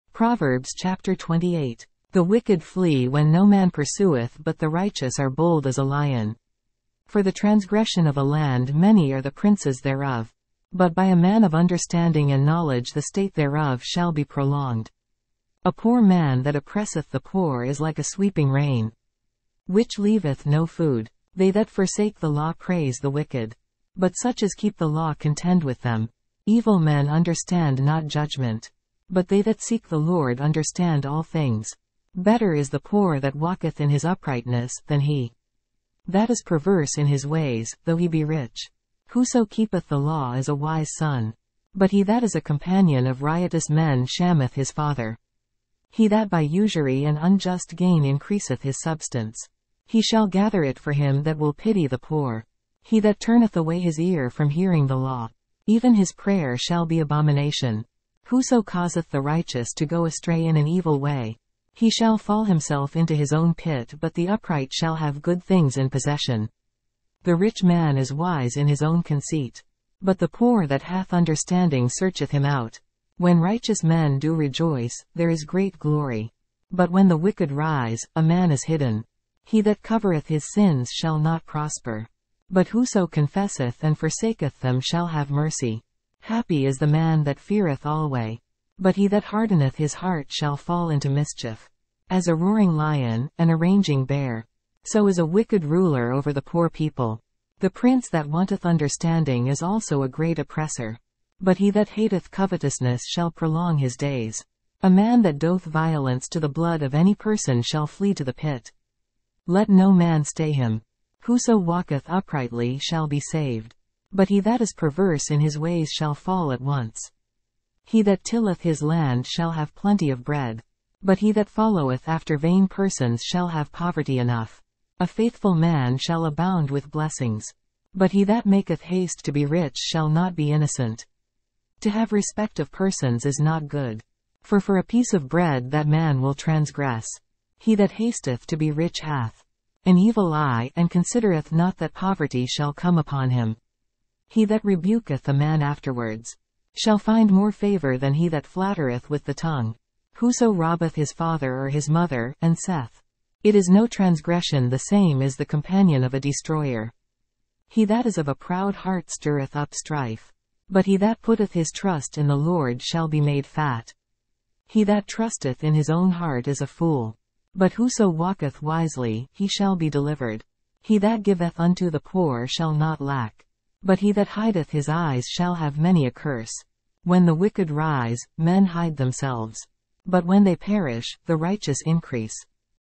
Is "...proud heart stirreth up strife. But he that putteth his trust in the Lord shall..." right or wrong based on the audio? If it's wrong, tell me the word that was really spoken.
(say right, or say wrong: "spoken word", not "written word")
right.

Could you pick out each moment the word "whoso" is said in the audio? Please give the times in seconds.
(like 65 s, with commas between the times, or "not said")
39 s, 58 s, 82 s, 111 s, 150 s, 167 s.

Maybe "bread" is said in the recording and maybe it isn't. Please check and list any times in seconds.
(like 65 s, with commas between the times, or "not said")
120 s, 135 s.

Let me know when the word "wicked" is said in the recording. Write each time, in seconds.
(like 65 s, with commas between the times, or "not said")
2 s, 23 s, 77 s, 95 s, 177 s.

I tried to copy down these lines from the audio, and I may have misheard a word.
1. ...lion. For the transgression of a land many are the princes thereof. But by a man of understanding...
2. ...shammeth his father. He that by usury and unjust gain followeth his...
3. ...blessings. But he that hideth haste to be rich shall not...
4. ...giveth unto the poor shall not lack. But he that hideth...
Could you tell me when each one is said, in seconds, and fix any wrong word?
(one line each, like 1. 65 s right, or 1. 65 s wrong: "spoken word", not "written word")
1. 5 s right
2. 44 s wrong: "increaseth", not "followeth"
3. 126 s wrong: "maketh", not "hideth"
4. 171 s right.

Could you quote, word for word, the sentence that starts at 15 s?
A poor man that oppresseth the poor is like a sweeping rain, which leaveth no food.